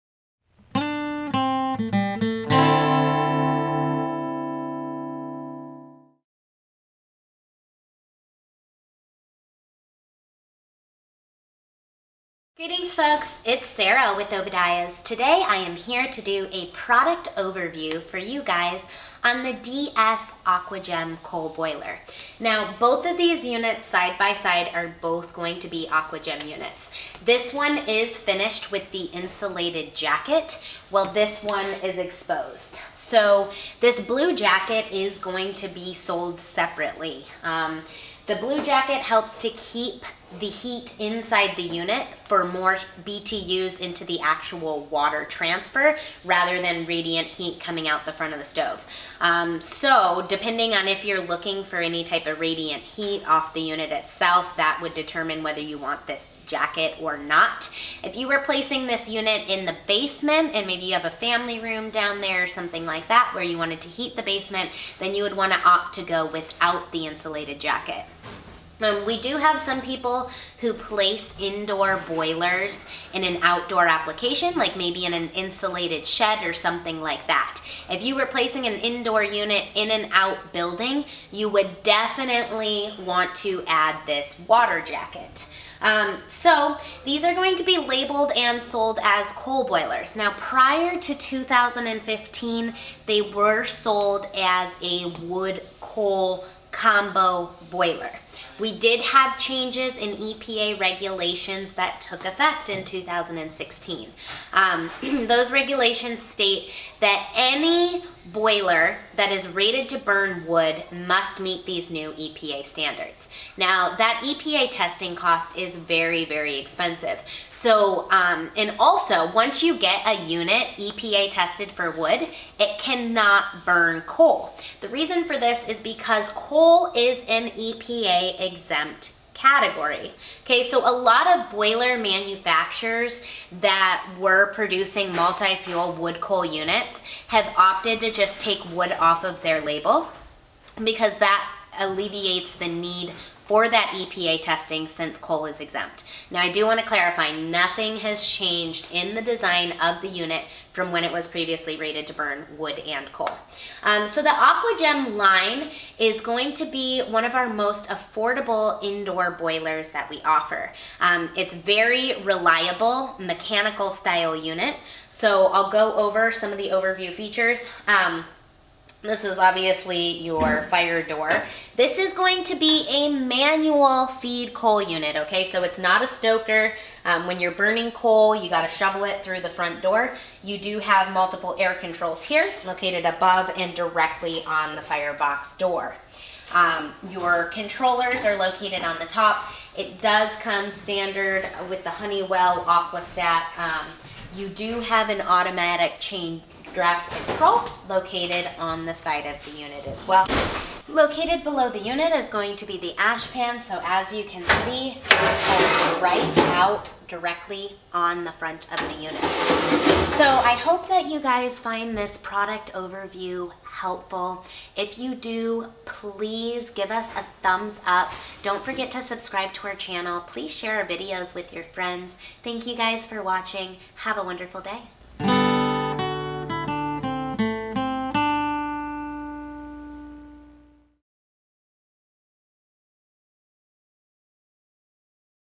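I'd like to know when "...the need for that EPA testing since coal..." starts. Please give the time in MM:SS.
02:22.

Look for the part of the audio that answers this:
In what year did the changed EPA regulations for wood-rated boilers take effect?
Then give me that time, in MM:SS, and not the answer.
01:42.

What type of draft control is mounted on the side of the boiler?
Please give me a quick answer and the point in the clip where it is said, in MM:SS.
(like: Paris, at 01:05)
Automatic chain draft control, at 03:15.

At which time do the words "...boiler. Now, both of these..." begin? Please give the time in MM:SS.
00:21.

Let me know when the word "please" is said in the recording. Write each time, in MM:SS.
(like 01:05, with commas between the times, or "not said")
03:35, 03:40.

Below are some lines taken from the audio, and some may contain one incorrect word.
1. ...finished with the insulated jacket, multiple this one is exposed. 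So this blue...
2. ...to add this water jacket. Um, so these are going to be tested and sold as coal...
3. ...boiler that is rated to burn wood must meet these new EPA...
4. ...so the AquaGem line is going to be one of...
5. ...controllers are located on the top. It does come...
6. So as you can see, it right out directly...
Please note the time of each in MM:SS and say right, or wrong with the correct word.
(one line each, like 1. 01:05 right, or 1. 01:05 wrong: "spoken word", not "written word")
1. 00:28 wrong: "while", not "multiple"
2. 01:23 wrong: "labeled", not "tested"
3. 01:48 right
4. 02:34 right
5. 03:07 right
6. 03:23 right.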